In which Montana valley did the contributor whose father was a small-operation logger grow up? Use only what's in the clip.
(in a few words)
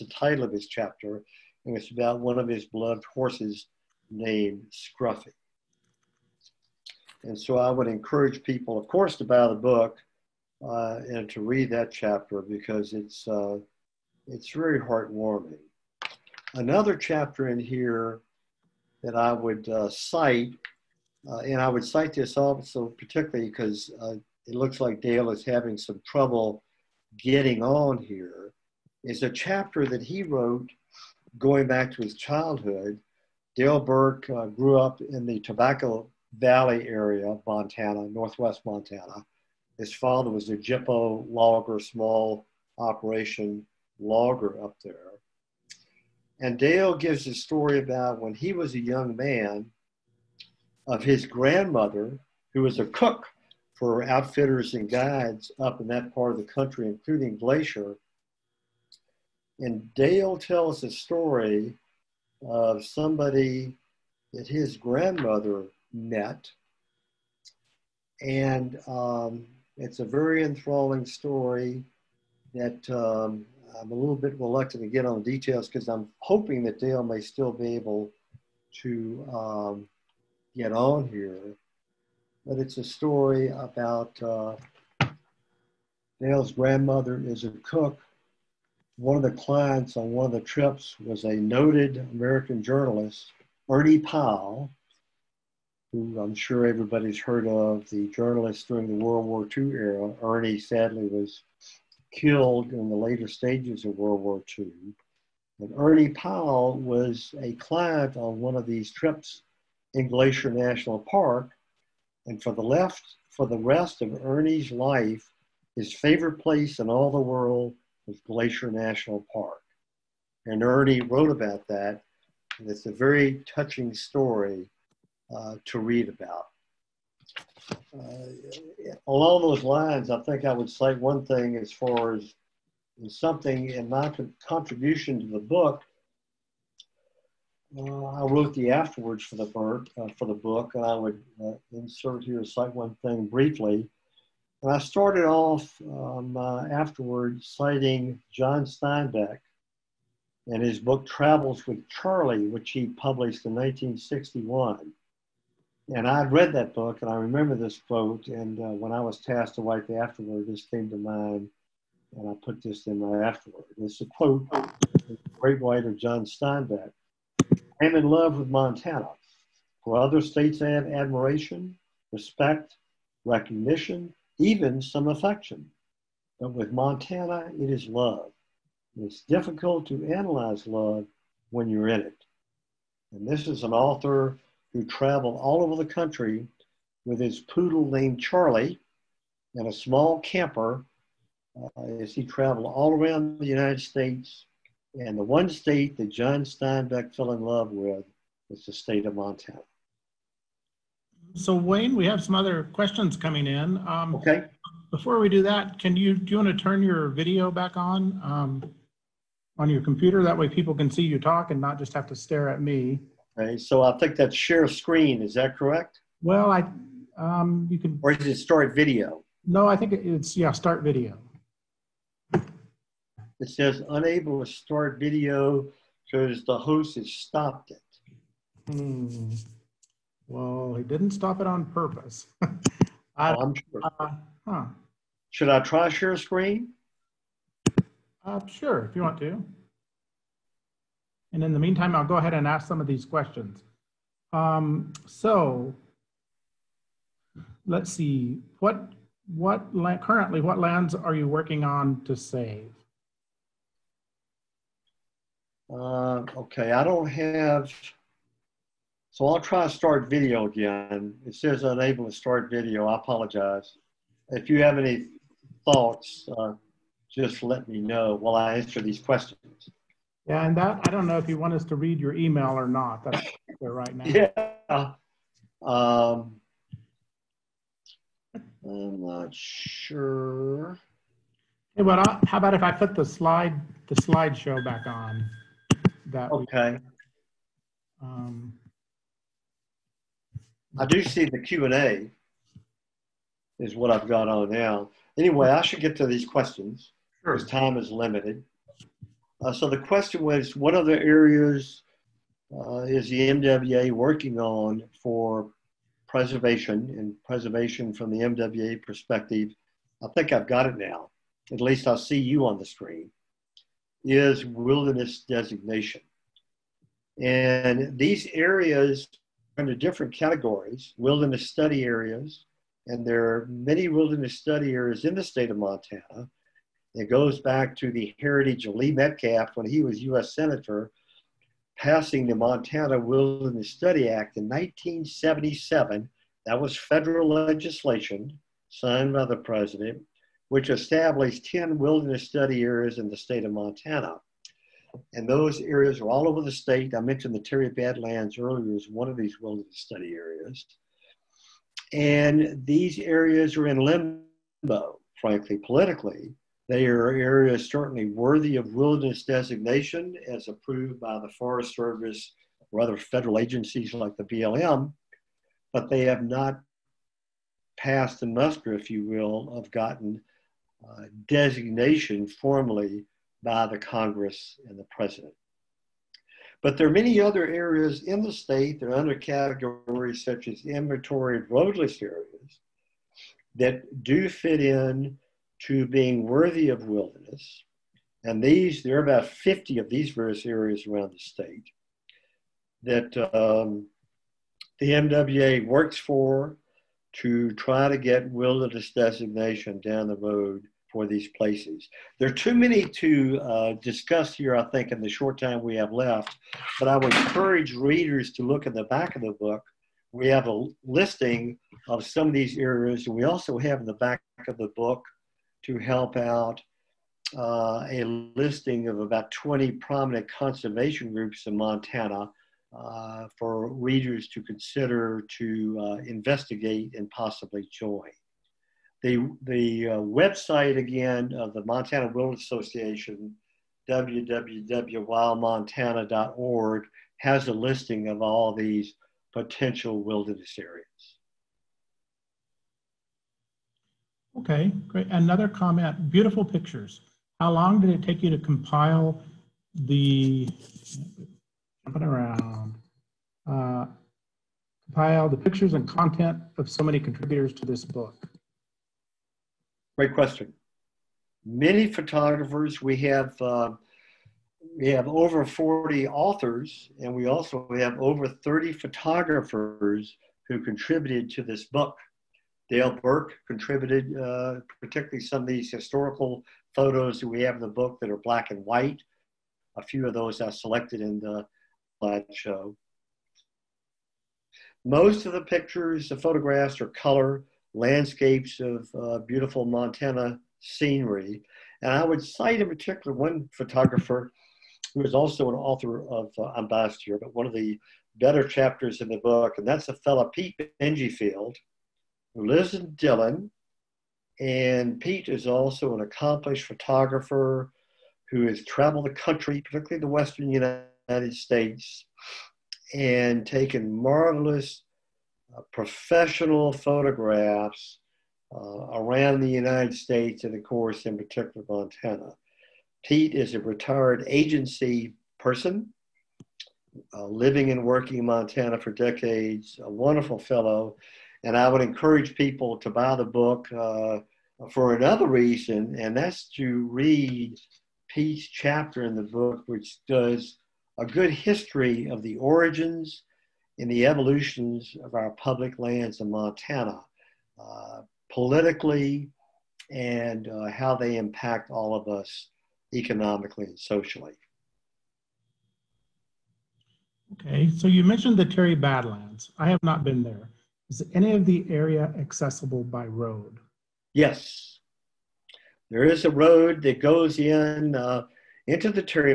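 Tobacco Valley.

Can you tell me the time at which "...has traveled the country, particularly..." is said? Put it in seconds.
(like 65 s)
508 s.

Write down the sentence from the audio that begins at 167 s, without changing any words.
I'm in love with Montana, For other states I have admiration, respect, recognition, even some affection.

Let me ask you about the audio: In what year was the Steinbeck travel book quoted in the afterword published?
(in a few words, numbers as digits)
1961.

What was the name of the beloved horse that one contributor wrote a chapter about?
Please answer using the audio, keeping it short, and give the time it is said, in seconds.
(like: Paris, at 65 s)
Scruffy, at 4 s.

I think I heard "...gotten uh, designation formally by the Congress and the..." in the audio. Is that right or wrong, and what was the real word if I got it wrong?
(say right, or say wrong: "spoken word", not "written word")
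right.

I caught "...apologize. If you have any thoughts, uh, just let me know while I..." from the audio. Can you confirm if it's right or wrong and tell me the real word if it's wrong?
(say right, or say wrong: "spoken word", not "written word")
right.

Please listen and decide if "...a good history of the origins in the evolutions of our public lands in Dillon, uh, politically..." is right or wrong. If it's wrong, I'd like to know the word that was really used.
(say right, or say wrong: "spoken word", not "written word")
wrong: "Montana", not "Dillon".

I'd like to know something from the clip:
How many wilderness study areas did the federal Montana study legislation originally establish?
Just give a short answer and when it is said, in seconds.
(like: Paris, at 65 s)
10, at 341 s.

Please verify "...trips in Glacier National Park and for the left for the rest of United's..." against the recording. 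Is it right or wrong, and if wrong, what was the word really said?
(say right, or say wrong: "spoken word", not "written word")
wrong: "Ernie", not "United".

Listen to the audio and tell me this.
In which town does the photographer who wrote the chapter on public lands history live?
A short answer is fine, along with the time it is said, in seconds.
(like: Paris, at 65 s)
Dillon, at 502 s.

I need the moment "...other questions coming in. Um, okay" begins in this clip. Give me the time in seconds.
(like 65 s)
202 s.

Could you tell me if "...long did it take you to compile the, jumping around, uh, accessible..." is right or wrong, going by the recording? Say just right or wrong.
wrong.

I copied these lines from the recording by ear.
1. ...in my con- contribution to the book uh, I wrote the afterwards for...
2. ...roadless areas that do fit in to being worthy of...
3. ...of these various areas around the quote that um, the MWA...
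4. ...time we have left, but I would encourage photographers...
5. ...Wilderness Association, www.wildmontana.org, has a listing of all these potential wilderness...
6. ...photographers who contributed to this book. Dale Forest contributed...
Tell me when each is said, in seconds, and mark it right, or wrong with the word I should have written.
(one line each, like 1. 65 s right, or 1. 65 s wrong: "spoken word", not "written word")
1. 133 s right
2. 381 s right
3. 389 s wrong: "state", not "quote"
4. 405 s wrong: "readers", not "photographers"
5. 432 s right
6. 468 s wrong: "Burk", not "Forest".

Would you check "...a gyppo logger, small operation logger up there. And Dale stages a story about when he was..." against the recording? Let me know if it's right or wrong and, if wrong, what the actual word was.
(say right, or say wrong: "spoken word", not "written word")
wrong: "gives", not "stages".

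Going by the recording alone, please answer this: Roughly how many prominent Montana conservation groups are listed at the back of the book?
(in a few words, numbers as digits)
20.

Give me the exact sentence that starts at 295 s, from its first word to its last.
Anyway, I should get to these questions because time is limited.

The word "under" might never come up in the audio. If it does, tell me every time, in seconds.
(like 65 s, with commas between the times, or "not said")
319 s, 378 s.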